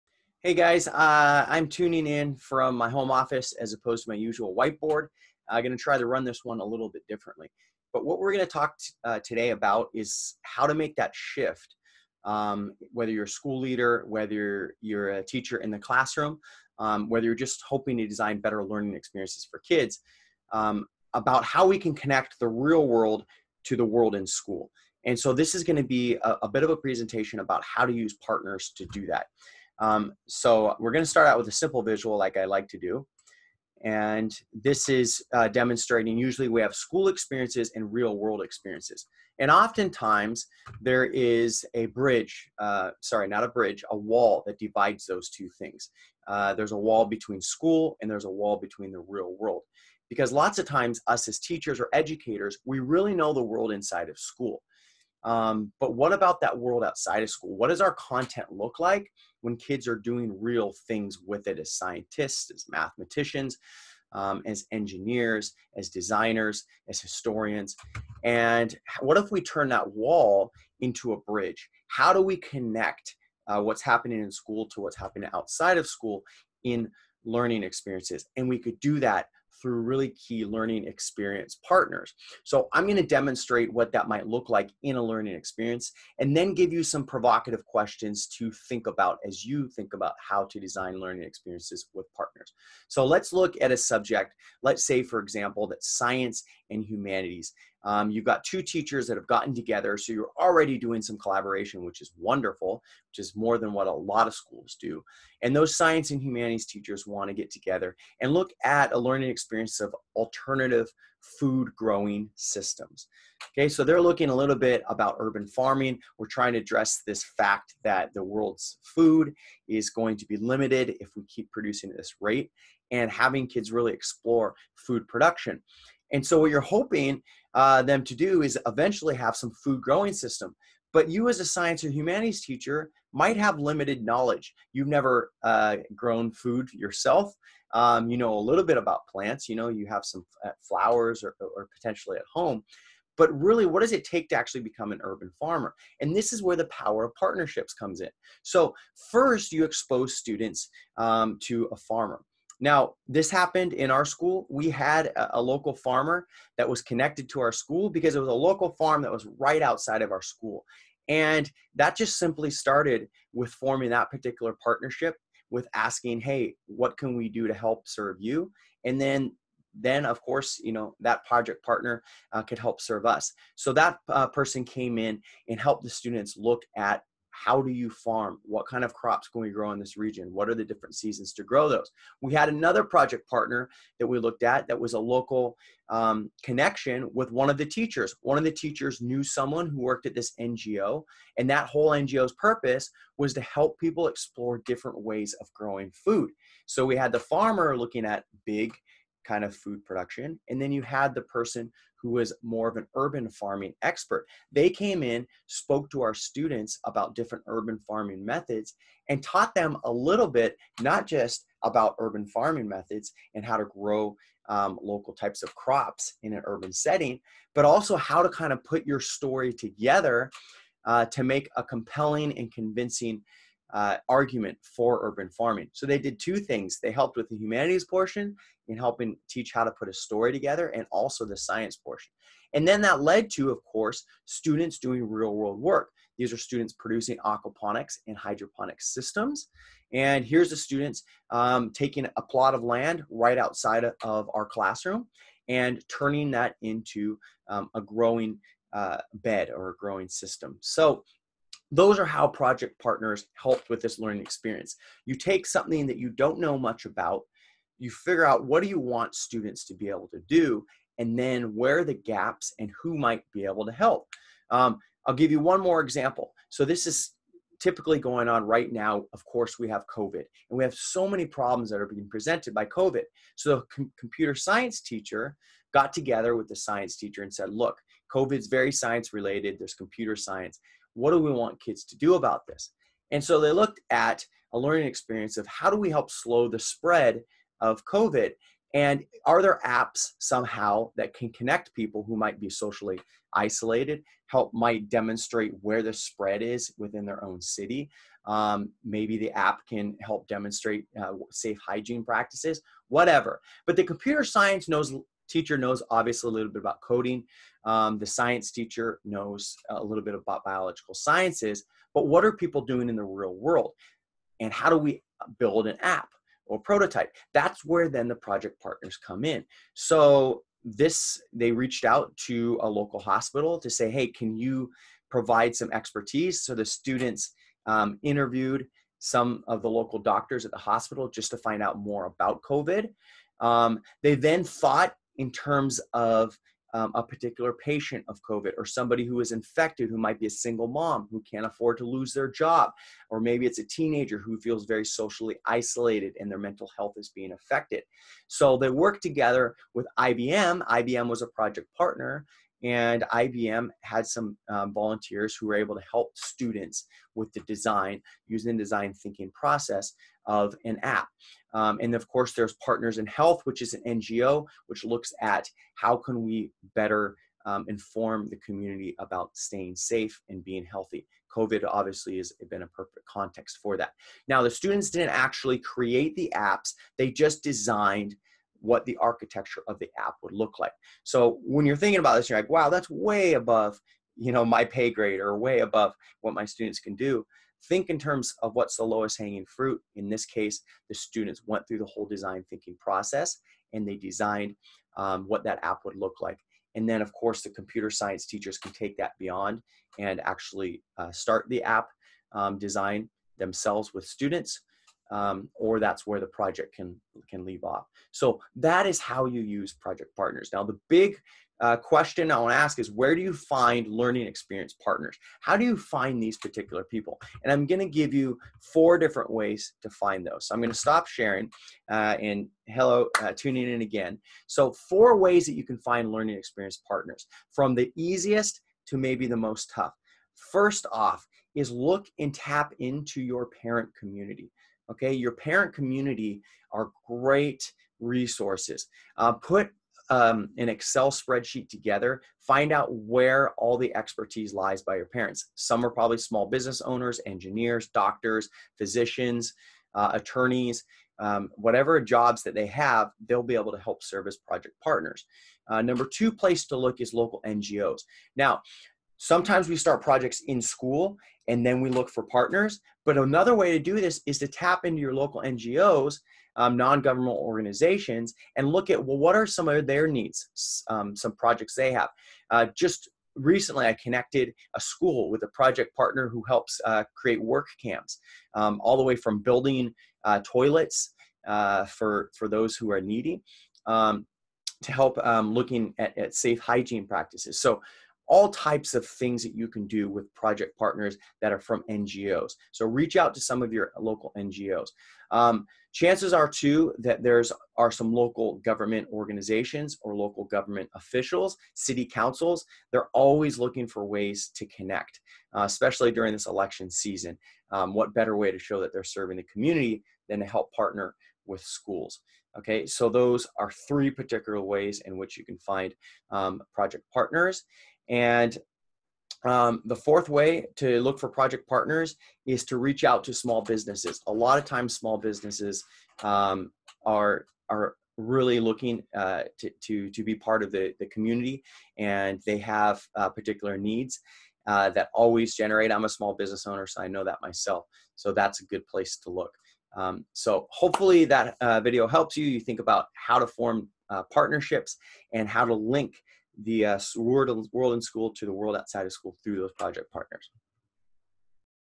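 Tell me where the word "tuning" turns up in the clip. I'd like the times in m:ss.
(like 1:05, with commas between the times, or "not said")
0:01, 7:03.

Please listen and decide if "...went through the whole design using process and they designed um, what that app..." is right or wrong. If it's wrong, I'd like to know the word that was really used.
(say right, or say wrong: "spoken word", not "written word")
wrong: "thinking", not "using".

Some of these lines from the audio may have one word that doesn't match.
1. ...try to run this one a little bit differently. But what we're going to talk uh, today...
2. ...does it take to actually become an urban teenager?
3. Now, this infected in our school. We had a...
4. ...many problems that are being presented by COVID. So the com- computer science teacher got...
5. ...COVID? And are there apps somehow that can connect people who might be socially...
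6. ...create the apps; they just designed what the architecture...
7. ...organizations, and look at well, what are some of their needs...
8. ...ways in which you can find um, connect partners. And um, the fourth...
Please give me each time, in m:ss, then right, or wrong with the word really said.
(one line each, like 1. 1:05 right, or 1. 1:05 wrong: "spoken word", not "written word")
1. 0:05 right
2. 2:23 wrong: "farmer", not "teenager"
3. 2:32 wrong: "happened", not "infected"
4. 4:31 right
5. 4:47 right
6. 6:15 right
7. 7:47 right
8. 8:34 wrong: "project", not "connect".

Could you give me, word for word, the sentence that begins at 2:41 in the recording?
And that just simply started with forming that particular partnership with asking, hey, what can we do to help serve you?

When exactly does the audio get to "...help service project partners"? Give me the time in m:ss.
7:33.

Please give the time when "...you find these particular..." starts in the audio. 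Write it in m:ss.
6:55.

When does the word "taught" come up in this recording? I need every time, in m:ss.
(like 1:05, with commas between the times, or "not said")
3:29.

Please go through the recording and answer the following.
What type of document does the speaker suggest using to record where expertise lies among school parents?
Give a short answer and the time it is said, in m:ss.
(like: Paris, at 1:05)
An Excel spreadsheet, at 7:20.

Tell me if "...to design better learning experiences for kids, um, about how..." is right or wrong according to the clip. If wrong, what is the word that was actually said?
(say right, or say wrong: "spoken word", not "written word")
right.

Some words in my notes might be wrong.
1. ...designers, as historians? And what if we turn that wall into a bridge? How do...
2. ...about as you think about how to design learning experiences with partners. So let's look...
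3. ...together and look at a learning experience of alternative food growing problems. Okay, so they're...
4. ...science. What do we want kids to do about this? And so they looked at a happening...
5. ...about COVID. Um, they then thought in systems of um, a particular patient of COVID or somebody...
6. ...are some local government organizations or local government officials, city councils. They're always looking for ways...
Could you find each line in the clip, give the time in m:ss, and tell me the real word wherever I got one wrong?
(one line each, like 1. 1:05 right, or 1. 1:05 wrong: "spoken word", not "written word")
1. 1:05 right
2. 1:28 right
3. 1:47 wrong: "systems", not "problems"
4. 4:40 wrong: "learning", not "happening"
5. 5:32 wrong: "terms", not "systems"
6. 8:17 right.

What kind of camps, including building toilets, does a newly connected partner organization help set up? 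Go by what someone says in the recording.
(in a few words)
Work camps.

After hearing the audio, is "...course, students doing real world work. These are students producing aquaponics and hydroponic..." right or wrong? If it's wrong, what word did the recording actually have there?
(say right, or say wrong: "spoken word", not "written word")
right.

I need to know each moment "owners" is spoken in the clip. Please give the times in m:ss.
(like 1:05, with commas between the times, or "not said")
7:26, 8:56.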